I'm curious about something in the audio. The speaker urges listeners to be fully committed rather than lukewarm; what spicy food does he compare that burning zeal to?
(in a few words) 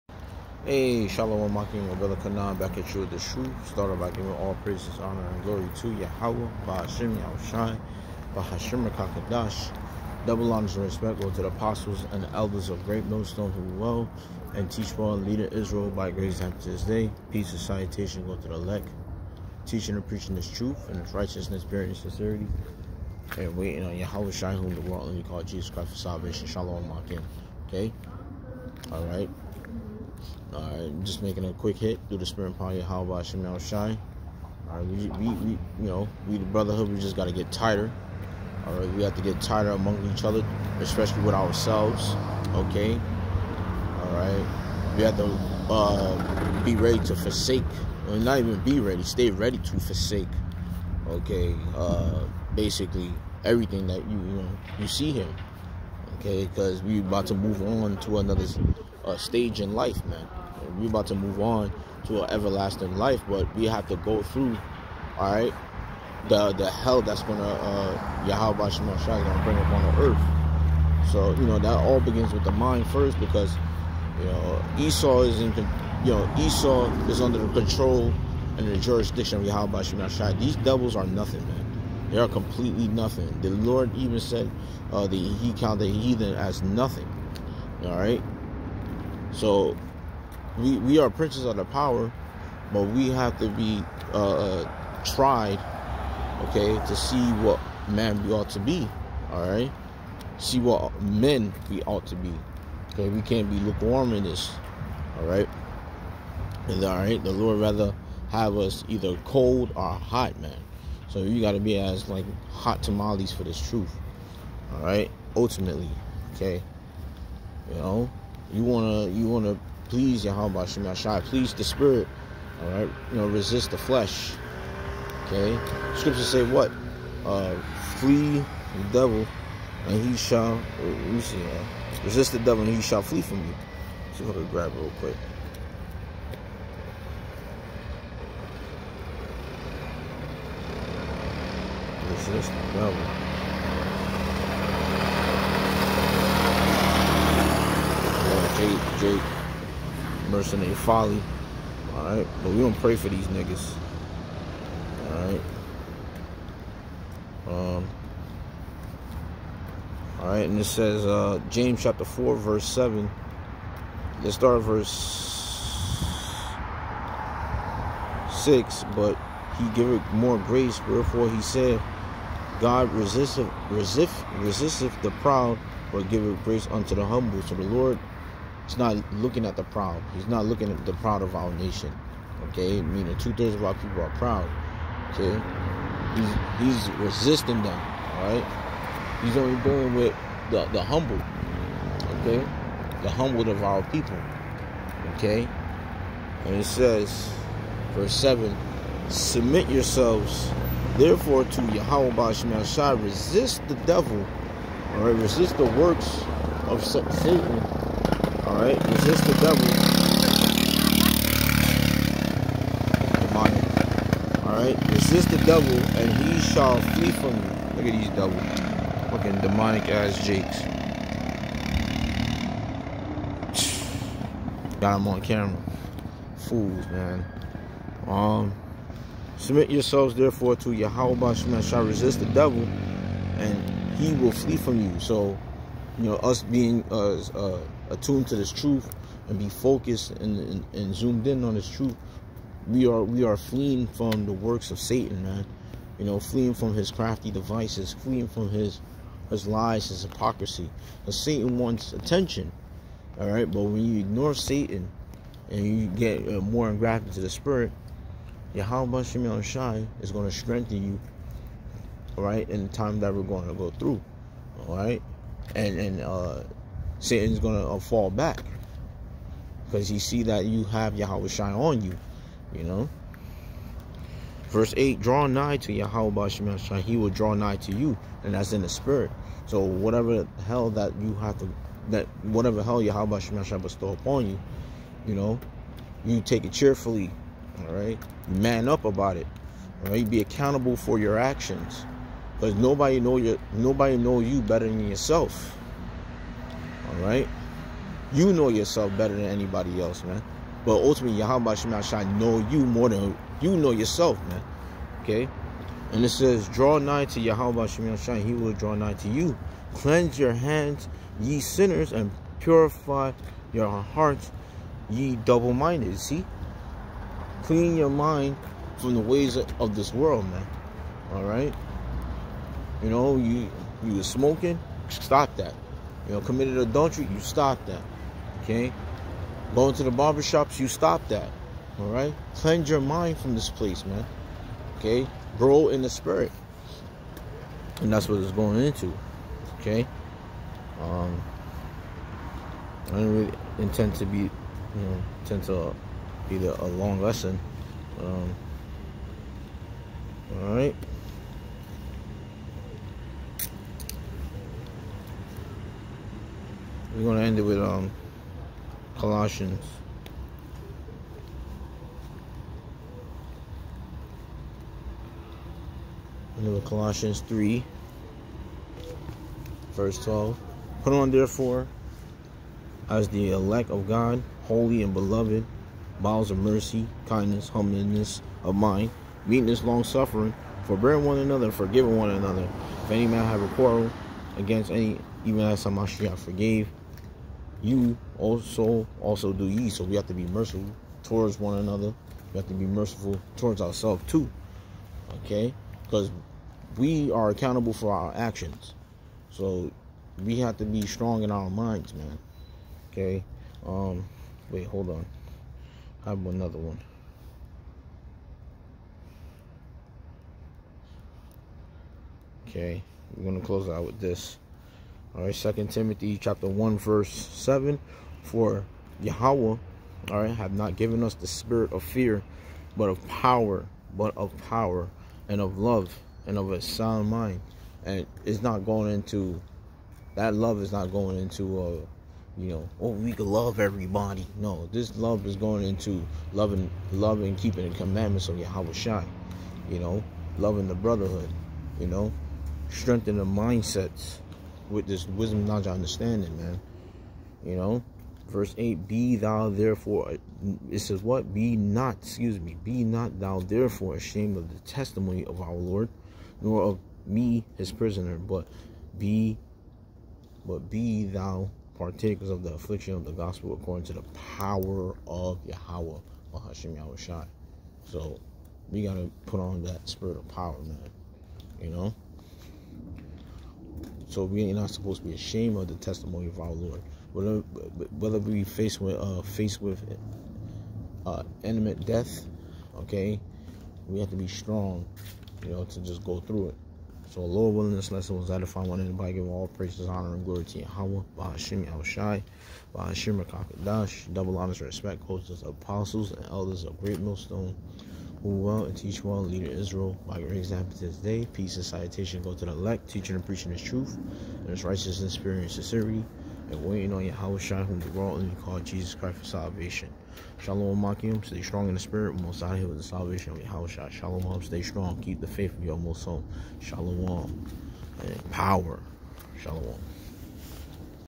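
hot tamales.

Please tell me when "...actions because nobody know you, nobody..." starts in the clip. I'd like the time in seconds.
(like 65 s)
291 s.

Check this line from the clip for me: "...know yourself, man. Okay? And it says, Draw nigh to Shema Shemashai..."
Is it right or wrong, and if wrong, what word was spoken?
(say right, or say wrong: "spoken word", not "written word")
wrong: "Yahweh", not "Shema".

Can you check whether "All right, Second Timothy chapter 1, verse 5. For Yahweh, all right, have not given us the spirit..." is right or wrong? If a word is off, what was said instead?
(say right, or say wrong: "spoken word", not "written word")
wrong: "7", not "5".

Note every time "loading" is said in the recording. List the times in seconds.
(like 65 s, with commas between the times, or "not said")
not said.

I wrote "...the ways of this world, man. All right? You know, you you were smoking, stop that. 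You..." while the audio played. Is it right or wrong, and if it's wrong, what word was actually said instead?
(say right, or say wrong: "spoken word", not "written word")
right.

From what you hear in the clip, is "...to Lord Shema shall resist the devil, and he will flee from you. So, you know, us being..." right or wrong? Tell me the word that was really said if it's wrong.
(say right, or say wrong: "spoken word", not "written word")
wrong: "Yahweh", not "Lord".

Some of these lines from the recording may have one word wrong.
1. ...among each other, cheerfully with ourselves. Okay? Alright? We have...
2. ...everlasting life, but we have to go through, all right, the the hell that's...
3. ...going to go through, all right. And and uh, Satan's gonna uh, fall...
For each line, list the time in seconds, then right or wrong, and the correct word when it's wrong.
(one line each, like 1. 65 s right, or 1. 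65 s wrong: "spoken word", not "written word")
1. 39 s wrong: "especially", not "cheerfully"
2. 62 s right
3. 263 s right.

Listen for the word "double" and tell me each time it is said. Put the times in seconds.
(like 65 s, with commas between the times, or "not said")
10 s, 218 s, 315 s, 494 s.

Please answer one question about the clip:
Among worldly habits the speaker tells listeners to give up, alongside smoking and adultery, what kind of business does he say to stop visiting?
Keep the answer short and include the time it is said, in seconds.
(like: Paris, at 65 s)
barbershops, at 329 s.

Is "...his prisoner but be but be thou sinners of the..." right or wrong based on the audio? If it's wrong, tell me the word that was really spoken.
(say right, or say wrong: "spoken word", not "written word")
wrong: "partakers", not "sinners".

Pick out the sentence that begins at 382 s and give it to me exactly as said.
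If any man have a quarrel against any, even as Hamashiach forgave you also also do ye.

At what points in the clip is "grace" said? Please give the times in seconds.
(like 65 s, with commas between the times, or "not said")
16 s, 170 s, 176 s.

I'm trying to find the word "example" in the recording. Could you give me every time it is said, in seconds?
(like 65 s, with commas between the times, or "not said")
500 s.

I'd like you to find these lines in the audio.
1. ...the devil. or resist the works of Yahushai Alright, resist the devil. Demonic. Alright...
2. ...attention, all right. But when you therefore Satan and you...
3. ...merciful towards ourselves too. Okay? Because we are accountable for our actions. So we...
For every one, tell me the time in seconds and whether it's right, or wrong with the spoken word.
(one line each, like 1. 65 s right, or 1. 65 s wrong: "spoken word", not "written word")
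1. 203 s wrong: "Satan", not "Yahushai"
2. 251 s wrong: "ignore", not "therefore"
3. 392 s right.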